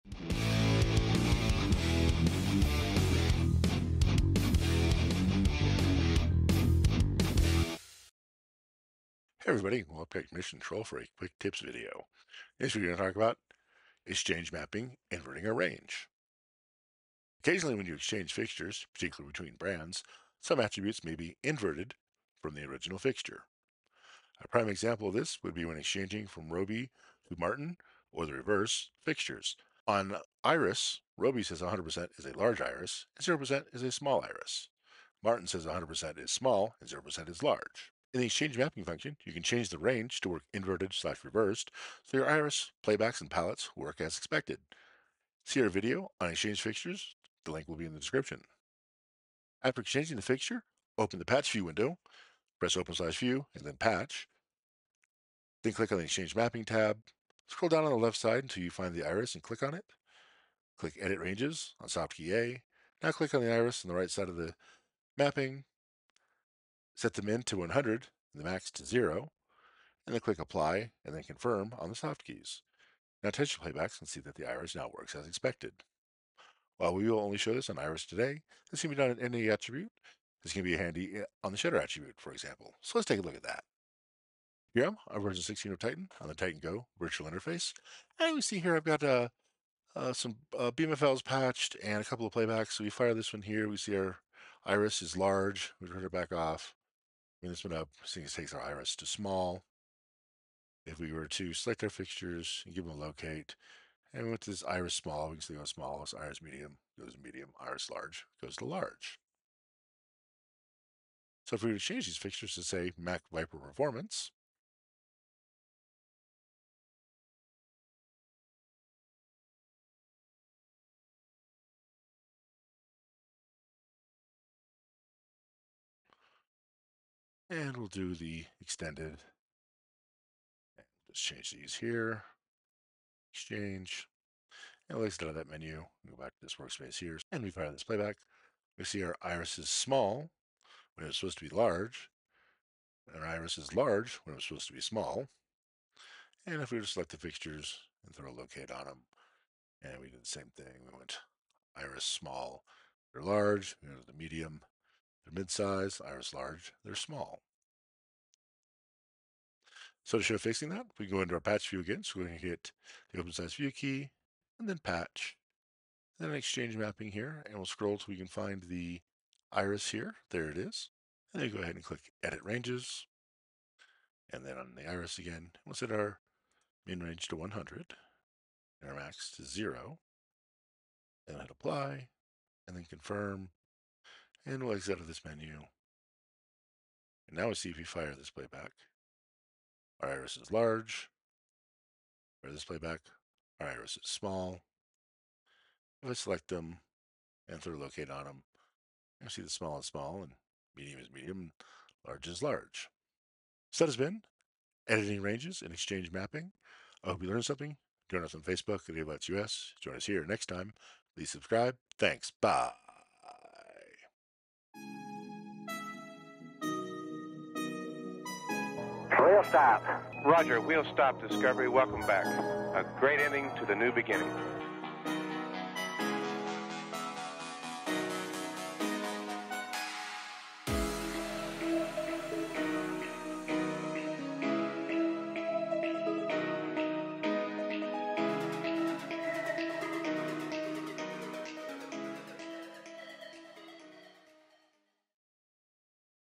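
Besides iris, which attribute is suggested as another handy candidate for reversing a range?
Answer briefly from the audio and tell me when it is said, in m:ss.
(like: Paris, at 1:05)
shutter, at 1:21.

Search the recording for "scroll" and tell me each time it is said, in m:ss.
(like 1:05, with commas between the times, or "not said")
0:57, 2:47.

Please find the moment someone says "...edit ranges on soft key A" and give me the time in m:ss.
1:00.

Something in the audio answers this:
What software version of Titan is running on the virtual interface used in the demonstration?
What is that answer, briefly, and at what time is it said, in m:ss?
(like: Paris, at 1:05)
16, at 1:25.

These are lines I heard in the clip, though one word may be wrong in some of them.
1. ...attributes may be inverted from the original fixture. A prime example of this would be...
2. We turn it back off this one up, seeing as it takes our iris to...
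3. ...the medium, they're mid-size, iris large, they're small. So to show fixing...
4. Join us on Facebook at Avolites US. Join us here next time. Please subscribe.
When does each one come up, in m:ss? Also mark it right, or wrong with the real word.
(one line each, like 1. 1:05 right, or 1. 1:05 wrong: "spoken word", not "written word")
1. 0:20 right
2. 1:35 right
3. 2:34 right
4. 3:28 right.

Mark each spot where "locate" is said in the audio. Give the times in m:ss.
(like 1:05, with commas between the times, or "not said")
1:42, 2:28, 3:17.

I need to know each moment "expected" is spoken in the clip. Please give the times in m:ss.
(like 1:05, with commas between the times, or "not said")
0:44, 1:15.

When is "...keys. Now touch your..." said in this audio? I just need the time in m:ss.
1:12.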